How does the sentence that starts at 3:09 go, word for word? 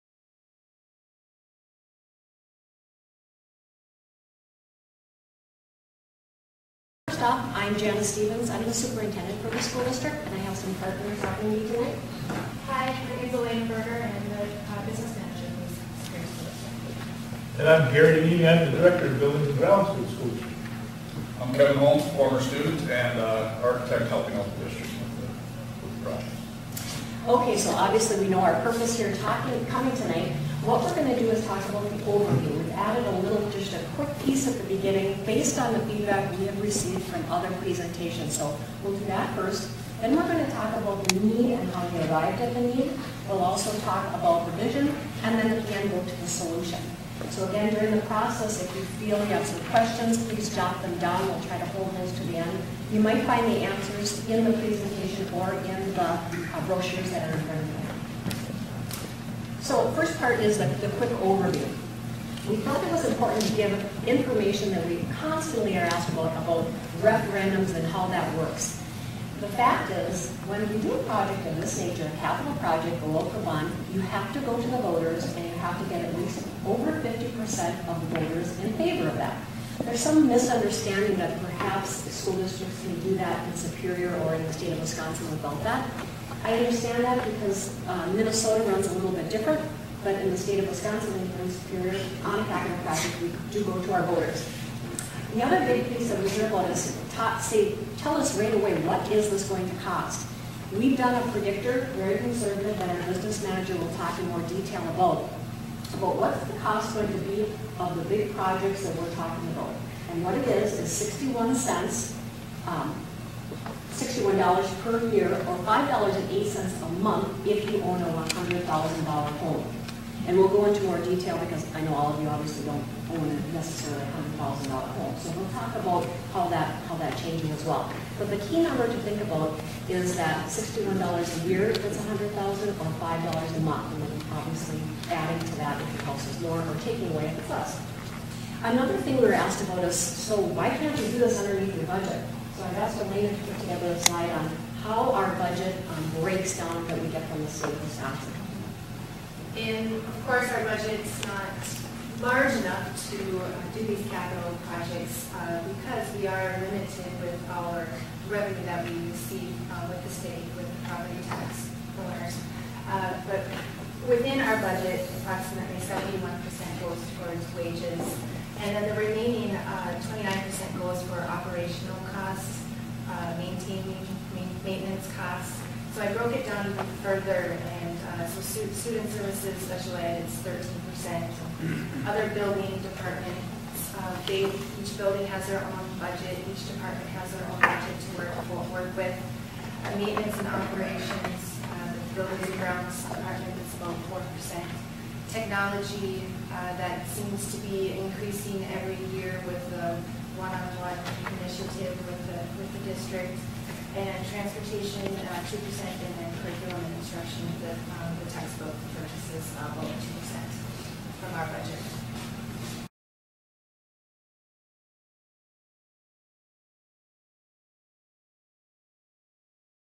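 Uh, maintenance and operations, the uh, buildings and grounds department is about 4%.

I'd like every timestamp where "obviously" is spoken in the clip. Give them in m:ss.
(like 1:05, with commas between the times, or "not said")
0:27, 2:02, 2:14.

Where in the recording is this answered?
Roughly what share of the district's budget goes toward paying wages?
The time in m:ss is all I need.
2:45.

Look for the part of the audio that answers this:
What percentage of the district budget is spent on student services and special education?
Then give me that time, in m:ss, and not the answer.
3:00.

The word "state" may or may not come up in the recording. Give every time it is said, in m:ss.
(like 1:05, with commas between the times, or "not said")
1:24, 1:30, 2:27, 2:40.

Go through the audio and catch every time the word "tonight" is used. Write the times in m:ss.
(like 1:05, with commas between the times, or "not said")
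0:11, 0:29.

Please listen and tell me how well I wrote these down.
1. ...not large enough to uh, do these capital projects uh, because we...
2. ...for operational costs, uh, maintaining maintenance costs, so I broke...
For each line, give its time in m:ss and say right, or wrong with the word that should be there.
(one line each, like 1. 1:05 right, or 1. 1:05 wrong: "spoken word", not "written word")
1. 2:31 right
2. 2:51 right.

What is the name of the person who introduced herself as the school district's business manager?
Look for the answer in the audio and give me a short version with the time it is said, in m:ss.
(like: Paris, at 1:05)
Elaine Berger, at 0:13.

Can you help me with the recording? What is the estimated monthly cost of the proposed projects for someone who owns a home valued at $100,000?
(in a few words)
$5.08.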